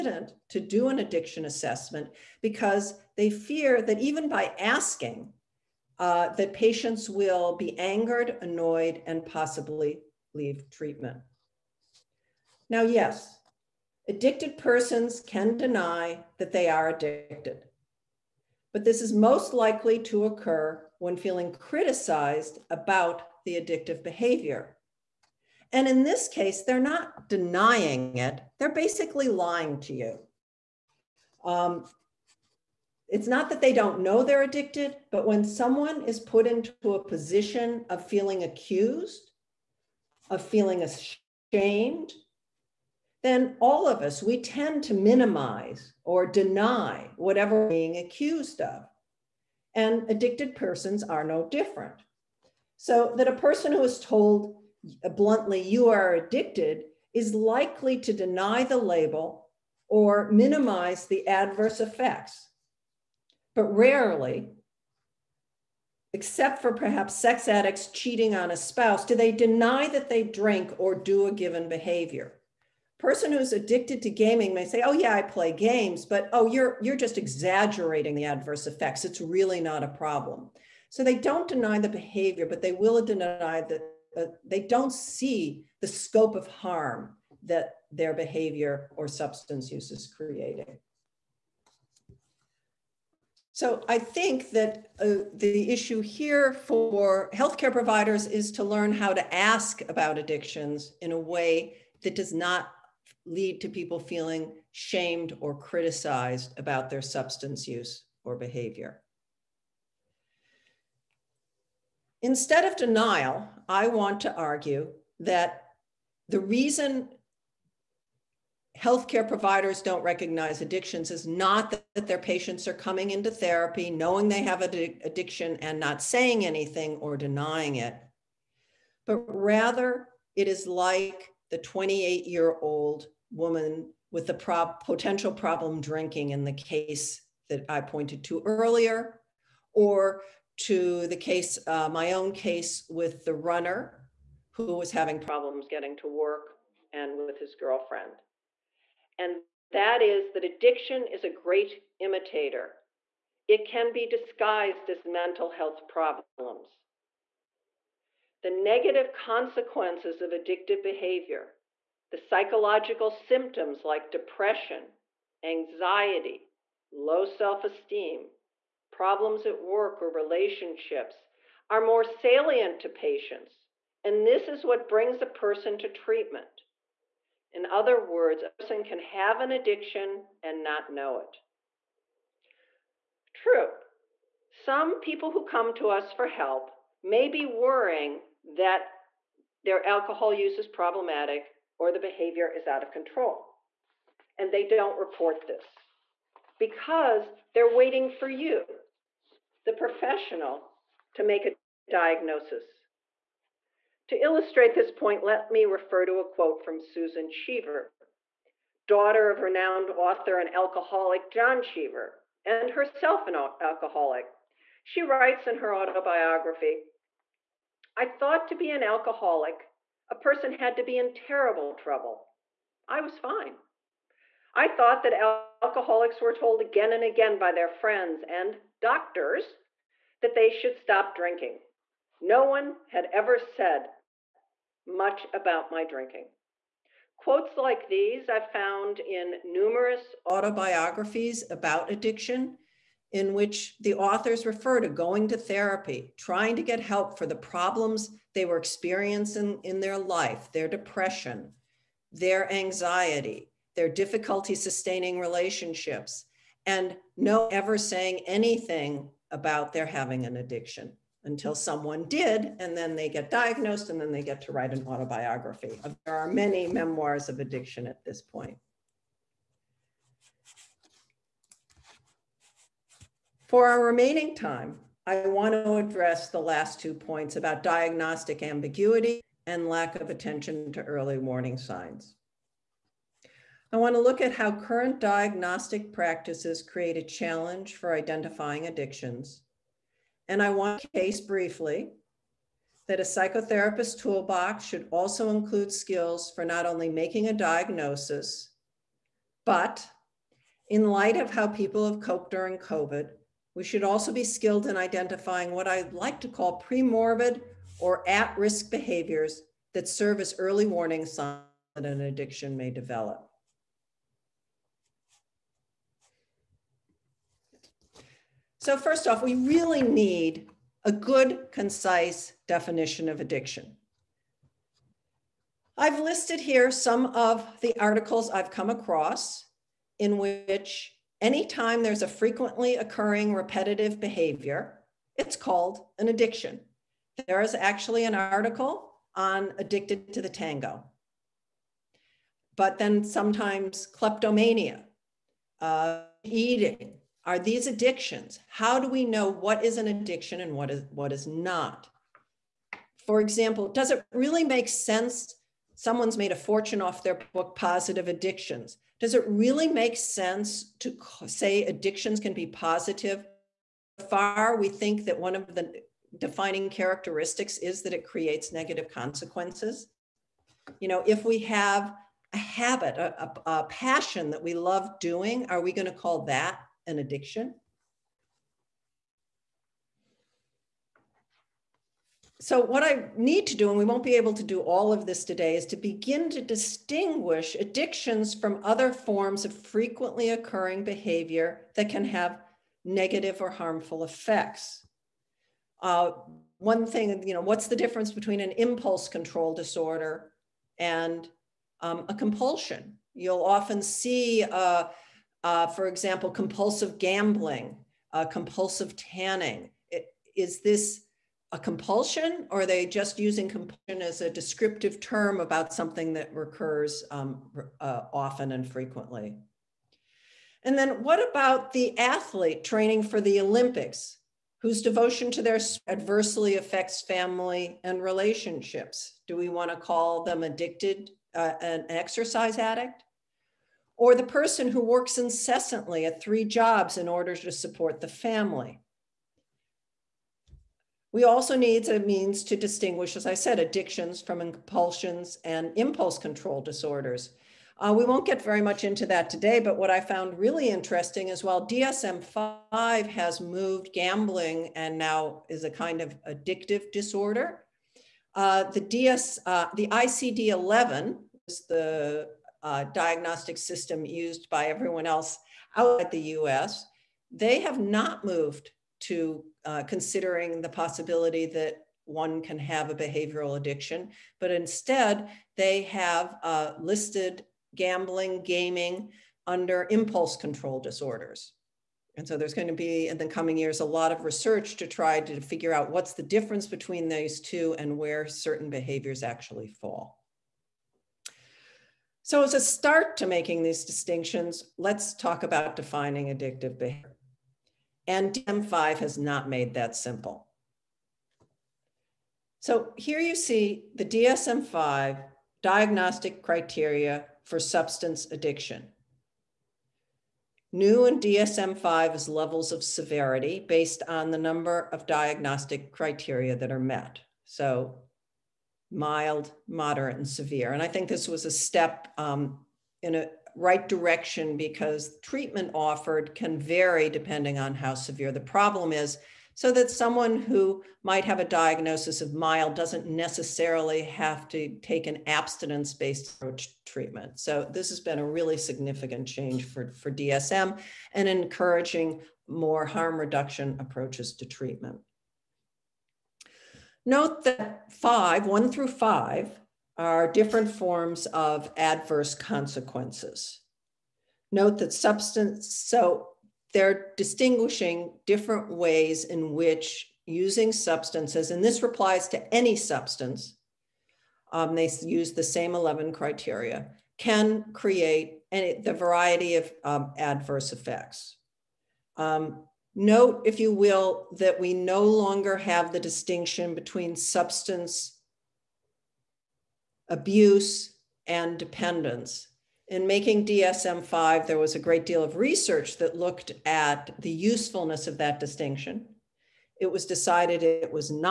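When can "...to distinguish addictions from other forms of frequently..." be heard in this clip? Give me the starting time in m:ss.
6:26.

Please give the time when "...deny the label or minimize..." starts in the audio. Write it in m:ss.
0:58.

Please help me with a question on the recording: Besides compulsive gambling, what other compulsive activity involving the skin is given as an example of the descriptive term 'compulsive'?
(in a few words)
tanning.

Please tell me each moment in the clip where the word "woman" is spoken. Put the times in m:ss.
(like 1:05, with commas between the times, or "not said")
2:13.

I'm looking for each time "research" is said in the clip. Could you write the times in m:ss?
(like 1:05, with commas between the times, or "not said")
8:04, 9:45.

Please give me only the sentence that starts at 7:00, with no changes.
And then what about the athlete training for the Olympics whose devotion to their adversely affects family and relationships?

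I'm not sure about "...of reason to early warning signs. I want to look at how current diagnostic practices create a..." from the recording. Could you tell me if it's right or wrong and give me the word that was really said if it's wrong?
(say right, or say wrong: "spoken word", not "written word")
wrong: "attention", not "reason".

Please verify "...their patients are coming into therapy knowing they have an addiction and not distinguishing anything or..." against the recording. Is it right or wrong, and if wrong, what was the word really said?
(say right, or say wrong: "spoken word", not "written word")
wrong: "saying", not "distinguishing".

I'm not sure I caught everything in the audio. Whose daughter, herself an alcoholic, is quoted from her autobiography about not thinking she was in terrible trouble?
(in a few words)
John Cheever.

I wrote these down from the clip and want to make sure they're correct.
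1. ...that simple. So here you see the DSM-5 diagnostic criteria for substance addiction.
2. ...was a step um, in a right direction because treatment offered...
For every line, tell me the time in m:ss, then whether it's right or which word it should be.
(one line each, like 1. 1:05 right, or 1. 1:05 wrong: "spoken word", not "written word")
1. 8:19 right
2. 8:41 right.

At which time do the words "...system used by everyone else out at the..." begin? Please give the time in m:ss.
7:43.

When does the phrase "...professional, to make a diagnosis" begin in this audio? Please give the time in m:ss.
3:19.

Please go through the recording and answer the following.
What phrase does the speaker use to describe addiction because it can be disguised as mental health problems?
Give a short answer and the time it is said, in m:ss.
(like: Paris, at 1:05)
a great imitator, at 2:31.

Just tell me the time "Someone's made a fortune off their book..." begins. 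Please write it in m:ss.
5:55.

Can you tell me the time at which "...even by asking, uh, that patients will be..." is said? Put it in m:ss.
0:03.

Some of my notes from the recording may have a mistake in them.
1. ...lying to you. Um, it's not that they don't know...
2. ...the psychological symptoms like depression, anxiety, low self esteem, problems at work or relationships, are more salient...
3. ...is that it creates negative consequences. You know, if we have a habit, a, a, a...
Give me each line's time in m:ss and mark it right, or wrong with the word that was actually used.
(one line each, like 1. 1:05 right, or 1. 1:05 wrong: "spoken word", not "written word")
1. 0:29 right
2. 2:42 right
3. 6:07 right.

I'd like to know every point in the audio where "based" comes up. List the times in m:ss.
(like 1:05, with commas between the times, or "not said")
8:33, 8:55.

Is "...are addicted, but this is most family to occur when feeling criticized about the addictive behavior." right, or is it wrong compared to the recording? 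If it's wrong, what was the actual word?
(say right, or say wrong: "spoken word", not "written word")
wrong: "likely", not "family".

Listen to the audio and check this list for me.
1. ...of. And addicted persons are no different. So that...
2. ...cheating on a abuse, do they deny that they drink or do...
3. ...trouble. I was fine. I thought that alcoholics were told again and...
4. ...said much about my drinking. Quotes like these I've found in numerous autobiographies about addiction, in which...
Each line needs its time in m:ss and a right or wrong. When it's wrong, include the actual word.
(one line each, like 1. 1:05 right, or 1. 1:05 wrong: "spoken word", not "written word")
1. 0:48 right
2. 1:07 wrong: "spouse", not "abuse"
3. 3:41 right
4. 3:53 right.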